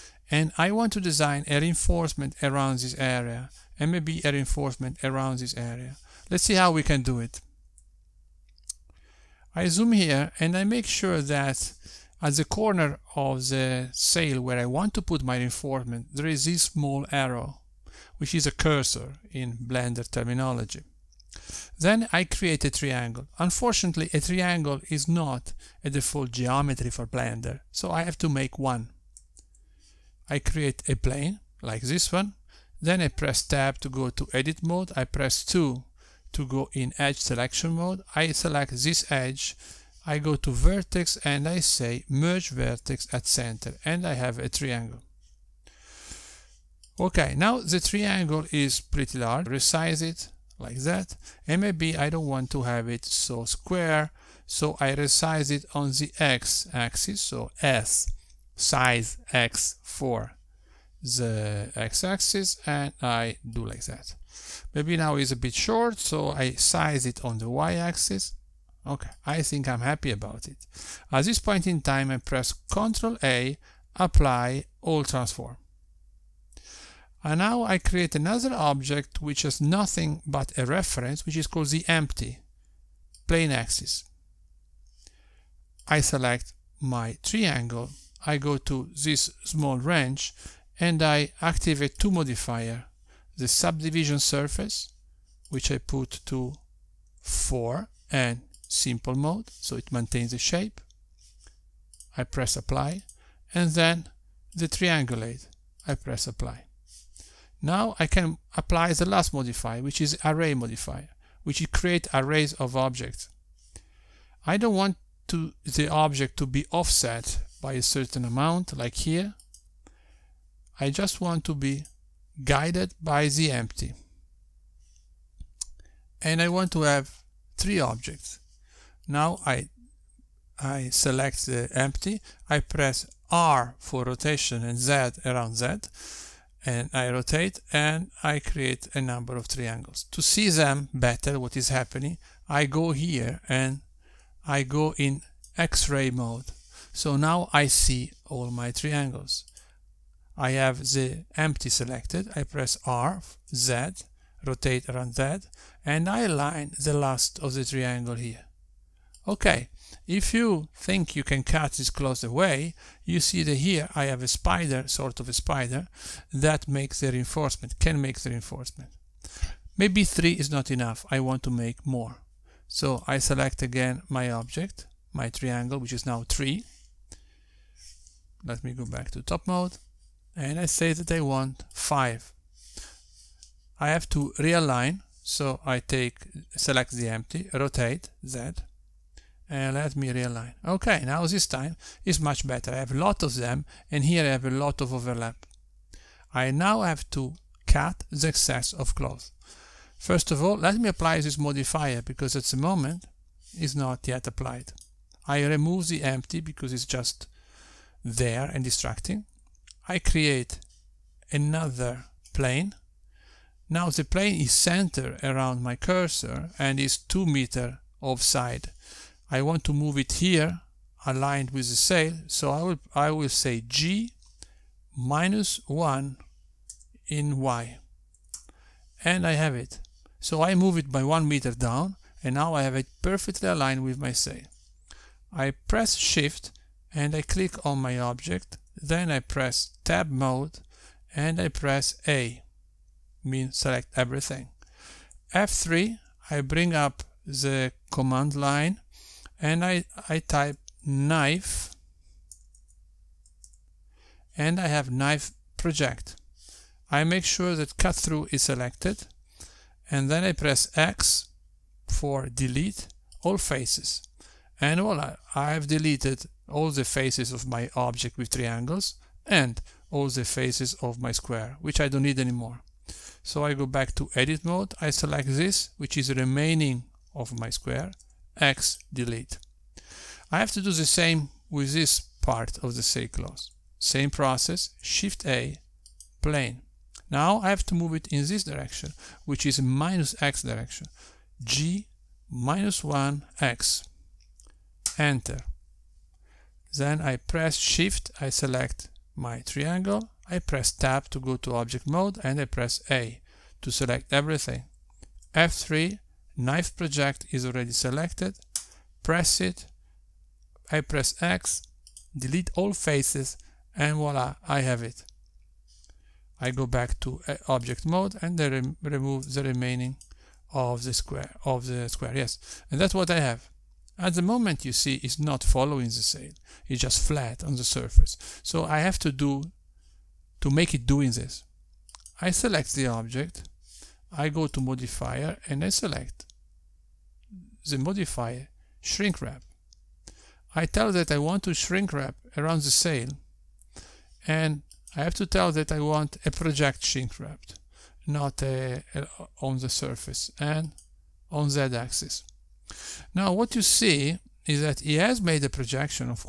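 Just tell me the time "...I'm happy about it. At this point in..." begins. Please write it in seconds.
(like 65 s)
69 s.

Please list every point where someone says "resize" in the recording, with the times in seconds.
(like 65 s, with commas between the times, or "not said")
49 s, 54 s.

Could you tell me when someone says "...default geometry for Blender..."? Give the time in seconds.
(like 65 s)
25 s.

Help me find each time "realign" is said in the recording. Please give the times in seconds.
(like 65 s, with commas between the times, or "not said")
184 s, 190 s.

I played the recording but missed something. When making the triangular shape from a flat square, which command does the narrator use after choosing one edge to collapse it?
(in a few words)
Merge vertex at center.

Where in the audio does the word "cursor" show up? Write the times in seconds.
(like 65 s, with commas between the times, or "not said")
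18 s, 215 s.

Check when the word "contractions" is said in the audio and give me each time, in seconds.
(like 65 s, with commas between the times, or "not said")
not said.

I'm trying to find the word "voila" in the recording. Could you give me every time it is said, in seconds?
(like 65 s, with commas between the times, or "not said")
264 s, 313 s.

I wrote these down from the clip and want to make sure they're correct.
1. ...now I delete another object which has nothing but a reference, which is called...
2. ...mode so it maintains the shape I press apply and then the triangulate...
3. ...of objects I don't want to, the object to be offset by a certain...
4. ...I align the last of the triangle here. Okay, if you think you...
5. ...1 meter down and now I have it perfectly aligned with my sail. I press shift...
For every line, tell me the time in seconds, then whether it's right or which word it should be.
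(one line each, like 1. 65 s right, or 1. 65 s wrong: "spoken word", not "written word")
1. 77 s wrong: "create", not "delete"
2. 99 s right
3. 112 s right
4. 156 s right
5. 231 s right.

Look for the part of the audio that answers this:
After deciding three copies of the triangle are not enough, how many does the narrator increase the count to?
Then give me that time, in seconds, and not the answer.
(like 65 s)
181 s.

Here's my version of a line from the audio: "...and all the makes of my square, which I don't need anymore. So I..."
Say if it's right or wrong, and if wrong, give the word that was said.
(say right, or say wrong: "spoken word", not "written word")
wrong: "faces", not "makes".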